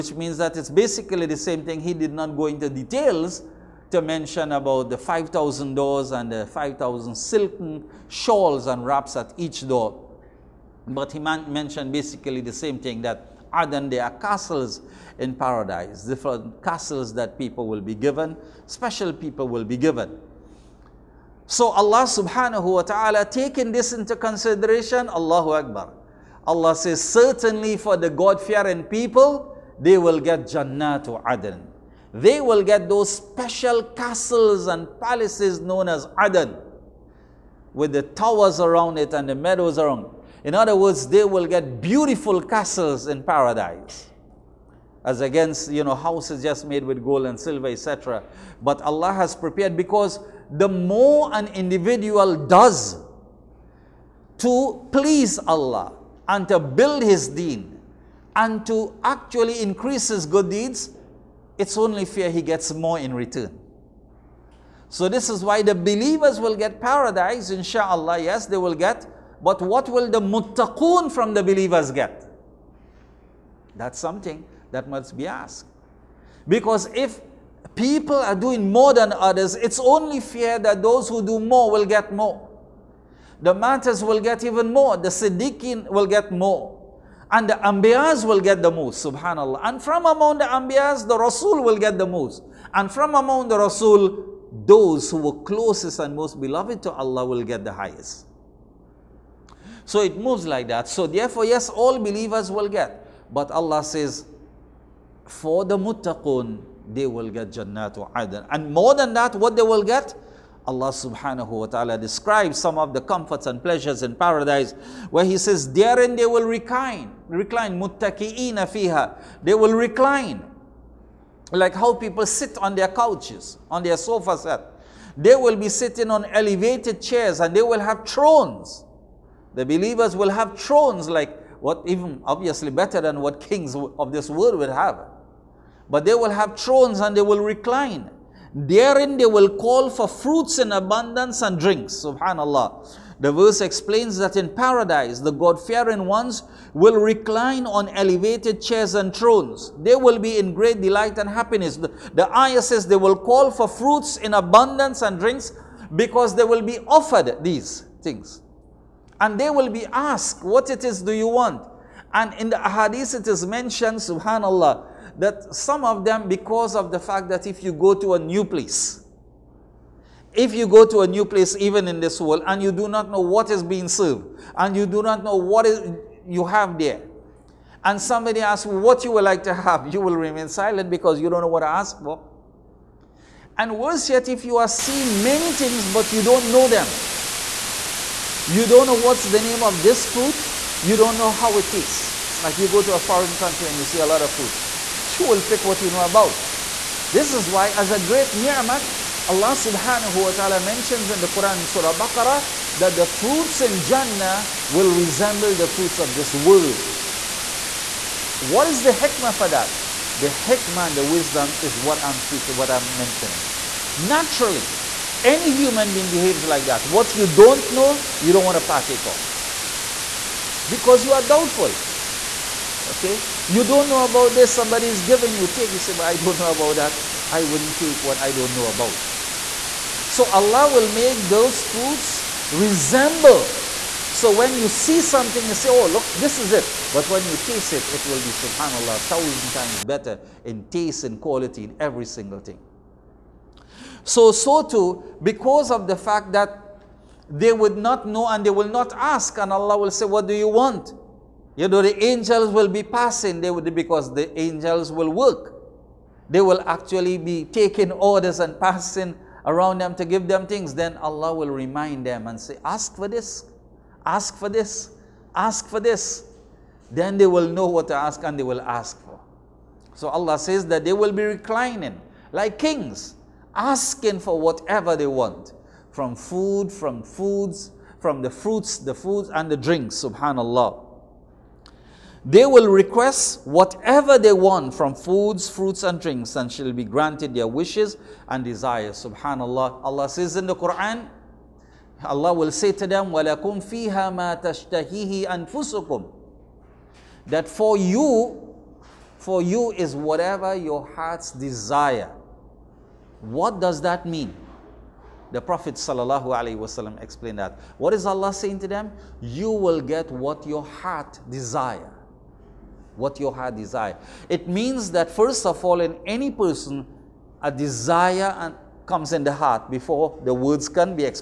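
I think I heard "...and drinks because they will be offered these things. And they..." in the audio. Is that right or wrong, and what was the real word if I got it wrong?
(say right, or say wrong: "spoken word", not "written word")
right.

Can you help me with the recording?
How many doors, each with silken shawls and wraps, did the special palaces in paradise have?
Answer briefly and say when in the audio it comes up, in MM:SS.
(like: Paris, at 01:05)
5,000, at 00:04.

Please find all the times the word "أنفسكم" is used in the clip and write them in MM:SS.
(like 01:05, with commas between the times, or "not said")
04:55.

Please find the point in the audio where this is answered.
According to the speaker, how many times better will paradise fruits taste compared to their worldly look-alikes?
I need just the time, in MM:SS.
03:59.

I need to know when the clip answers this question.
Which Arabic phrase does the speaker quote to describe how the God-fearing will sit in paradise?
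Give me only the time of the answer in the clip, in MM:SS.
01:57.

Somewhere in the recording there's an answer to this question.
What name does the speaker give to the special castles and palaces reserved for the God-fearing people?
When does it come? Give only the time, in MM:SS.
00:30.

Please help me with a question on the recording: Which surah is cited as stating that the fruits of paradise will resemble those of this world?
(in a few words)
Surah Baqarah.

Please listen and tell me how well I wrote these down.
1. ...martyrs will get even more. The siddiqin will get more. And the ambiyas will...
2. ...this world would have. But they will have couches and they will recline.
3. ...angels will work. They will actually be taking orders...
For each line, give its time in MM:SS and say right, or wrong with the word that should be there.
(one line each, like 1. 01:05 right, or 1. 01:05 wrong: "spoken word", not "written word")
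1. 01:23 right
2. 02:14 wrong: "thrones", not "couches"
3. 04:14 right.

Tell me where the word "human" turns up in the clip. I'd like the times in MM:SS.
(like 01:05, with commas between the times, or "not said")
03:35.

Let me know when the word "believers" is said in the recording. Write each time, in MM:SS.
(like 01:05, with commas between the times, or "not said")
01:05, 01:11, 01:41, 02:09.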